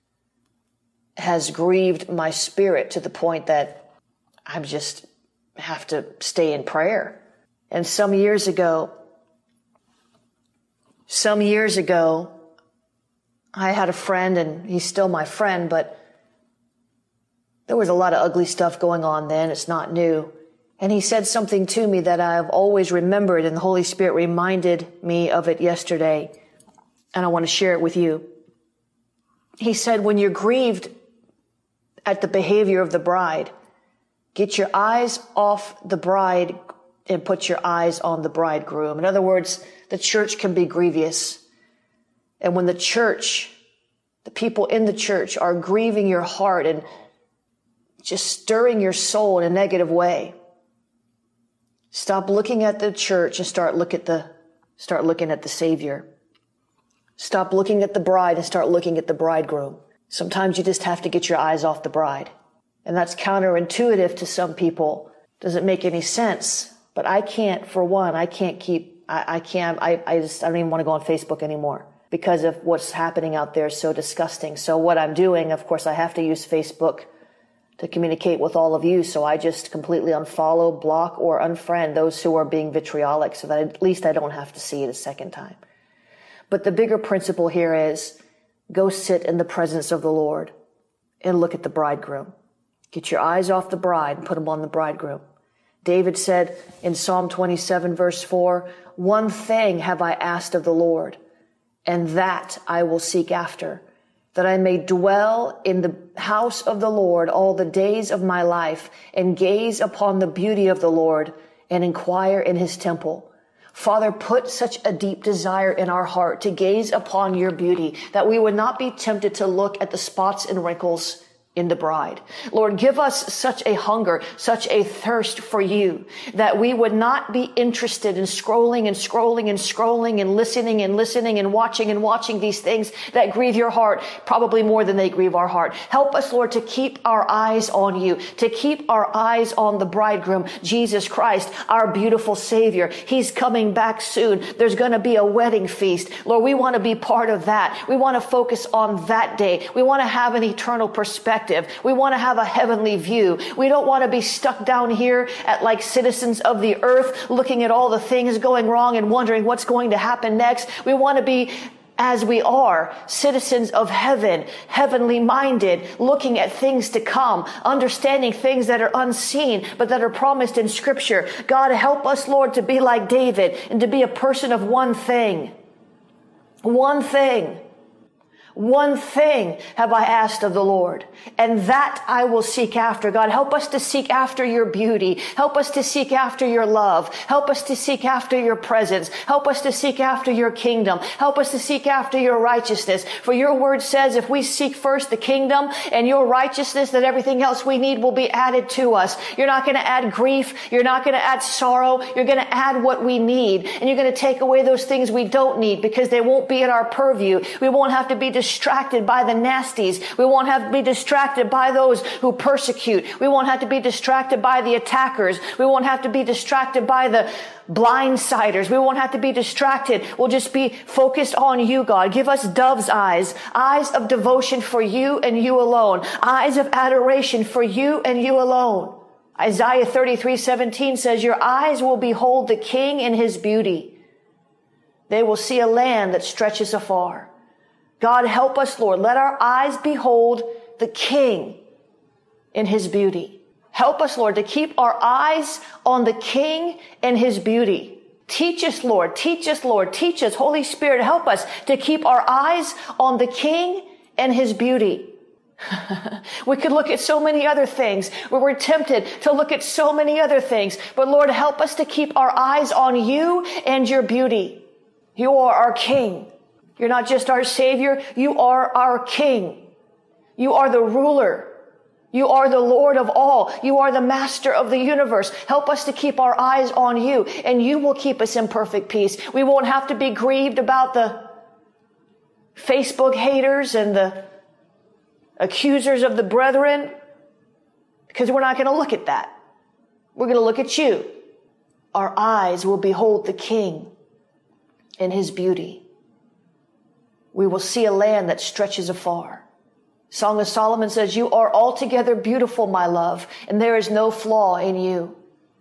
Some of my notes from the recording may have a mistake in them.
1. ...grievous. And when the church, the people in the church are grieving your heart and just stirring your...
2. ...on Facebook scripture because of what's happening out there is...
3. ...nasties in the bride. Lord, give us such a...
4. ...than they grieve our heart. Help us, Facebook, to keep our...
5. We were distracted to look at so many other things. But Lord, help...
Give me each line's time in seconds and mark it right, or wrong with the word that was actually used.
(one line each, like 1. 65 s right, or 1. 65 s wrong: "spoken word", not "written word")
1. 40 s right
2. 70 s wrong: "anymore", not "scripture"
3. 120 s wrong: "wrinkles", not "nasties"
4. 134 s wrong: "Lord", not "Facebook"
5. 258 s wrong: "tempted", not "distracted".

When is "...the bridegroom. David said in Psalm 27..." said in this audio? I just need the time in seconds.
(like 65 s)
94 s.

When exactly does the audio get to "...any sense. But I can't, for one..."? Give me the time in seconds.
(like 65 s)
65 s.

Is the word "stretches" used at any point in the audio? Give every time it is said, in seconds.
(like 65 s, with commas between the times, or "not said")
236 s, 298 s.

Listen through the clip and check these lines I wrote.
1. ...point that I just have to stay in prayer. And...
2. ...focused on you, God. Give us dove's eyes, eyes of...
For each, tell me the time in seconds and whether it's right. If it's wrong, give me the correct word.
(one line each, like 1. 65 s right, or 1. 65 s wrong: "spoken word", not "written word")
1. 3 s right
2. 220 s right.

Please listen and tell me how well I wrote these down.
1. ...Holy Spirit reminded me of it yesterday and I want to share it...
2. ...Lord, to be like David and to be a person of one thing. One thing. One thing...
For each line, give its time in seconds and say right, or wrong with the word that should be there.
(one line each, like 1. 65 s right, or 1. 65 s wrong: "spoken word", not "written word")
1. 23 s right
2. 172 s right.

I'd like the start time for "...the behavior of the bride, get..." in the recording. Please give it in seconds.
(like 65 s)
32 s.